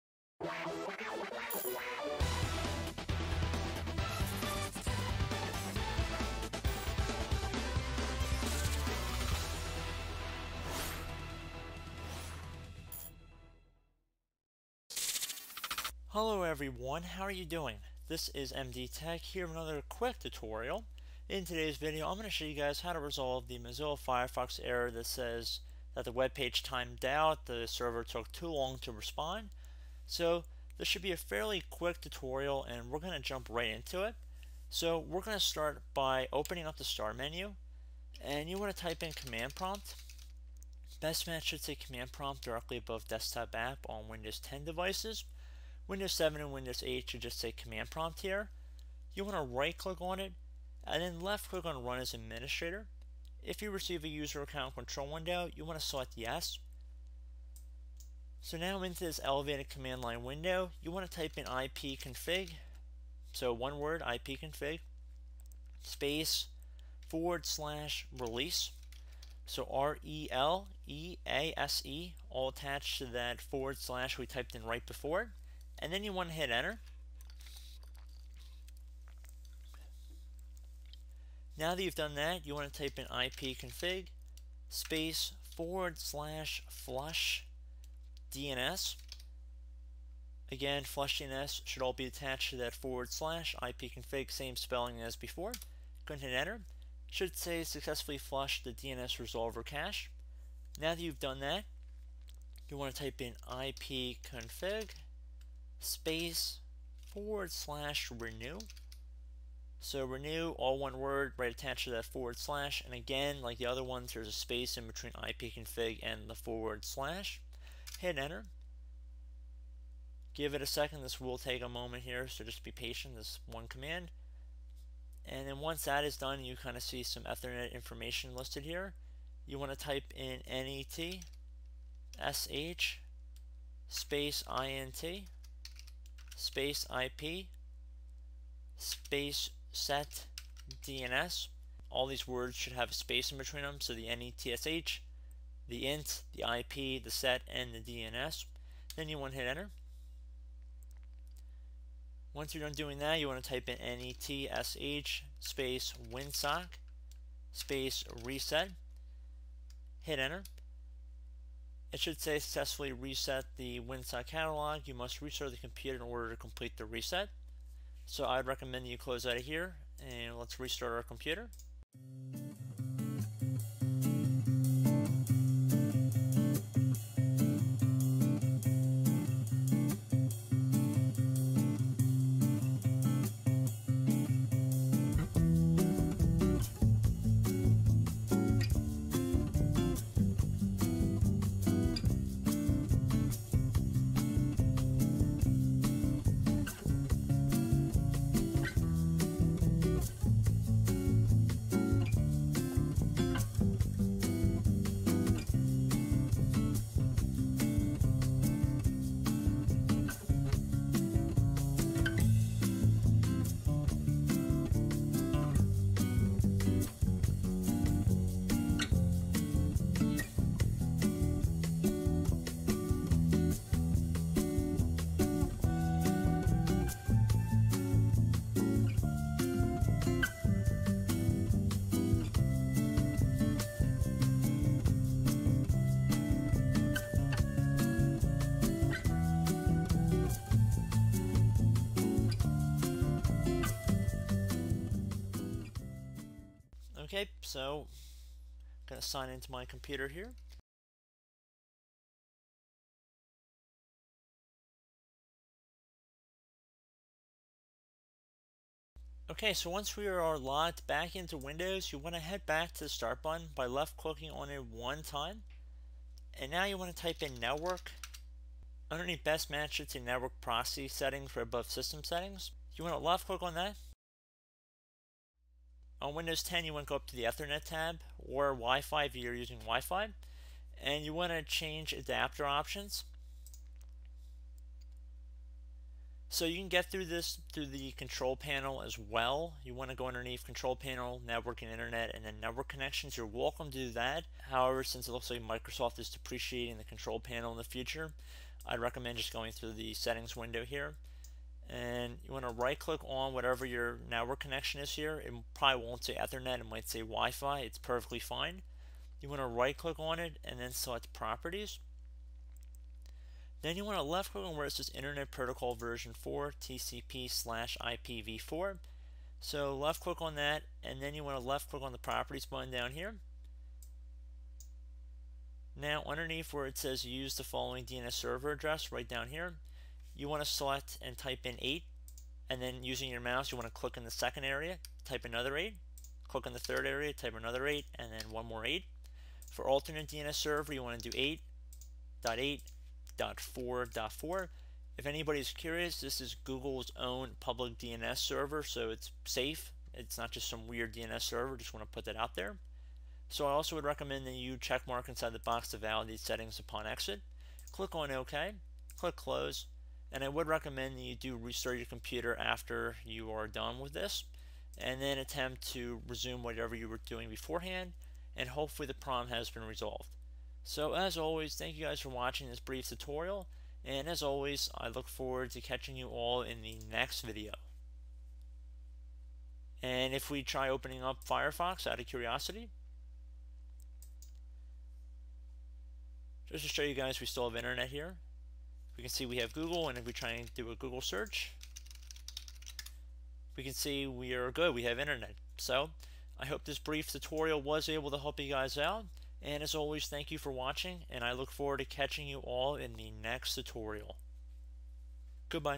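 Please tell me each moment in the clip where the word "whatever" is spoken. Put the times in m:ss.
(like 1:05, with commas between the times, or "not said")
5:03, 6:06.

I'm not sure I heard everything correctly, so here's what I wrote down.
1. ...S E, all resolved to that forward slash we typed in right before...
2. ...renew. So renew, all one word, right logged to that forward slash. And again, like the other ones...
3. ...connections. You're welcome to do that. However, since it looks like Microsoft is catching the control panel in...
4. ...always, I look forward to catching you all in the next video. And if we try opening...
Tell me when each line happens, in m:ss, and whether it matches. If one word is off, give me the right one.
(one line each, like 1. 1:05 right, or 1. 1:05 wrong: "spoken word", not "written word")
1. 1:11 wrong: "attached", not "resolved"
2. 1:48 wrong: "attached", not "logged"
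3. 4:52 wrong: "depreciating", not "catching"
4. 6:14 right.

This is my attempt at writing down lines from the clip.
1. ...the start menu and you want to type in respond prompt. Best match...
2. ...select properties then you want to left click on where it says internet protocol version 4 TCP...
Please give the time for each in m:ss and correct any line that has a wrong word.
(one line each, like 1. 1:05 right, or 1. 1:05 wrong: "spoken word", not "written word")
1. 0:36 wrong: "command", not "respond"
2. 5:10 right.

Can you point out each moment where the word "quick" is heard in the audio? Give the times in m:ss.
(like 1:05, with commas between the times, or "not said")
0:19, 0:31.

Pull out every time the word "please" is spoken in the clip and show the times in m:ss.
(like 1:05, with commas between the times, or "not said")
not said.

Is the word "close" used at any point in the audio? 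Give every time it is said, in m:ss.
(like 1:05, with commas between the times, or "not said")
2:48, 5:59.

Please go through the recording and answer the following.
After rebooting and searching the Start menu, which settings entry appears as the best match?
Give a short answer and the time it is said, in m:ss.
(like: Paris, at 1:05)
Network Proxy Settings, at 4:29.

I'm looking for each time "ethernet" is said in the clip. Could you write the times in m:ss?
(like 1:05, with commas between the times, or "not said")
2:07, 4:37, 5:06.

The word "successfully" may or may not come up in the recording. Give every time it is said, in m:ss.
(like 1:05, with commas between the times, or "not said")
1:37, 2:42.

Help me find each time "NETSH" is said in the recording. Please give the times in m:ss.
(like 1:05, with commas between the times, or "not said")
2:24, 2:33.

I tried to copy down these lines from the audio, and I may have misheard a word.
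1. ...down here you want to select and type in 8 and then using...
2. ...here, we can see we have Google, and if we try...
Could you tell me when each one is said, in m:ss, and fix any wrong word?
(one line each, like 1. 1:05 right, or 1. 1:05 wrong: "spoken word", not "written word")
1. 5:29 right
2. 6:27 right.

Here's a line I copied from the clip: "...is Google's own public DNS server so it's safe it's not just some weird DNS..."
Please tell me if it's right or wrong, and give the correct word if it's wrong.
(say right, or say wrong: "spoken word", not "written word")
right.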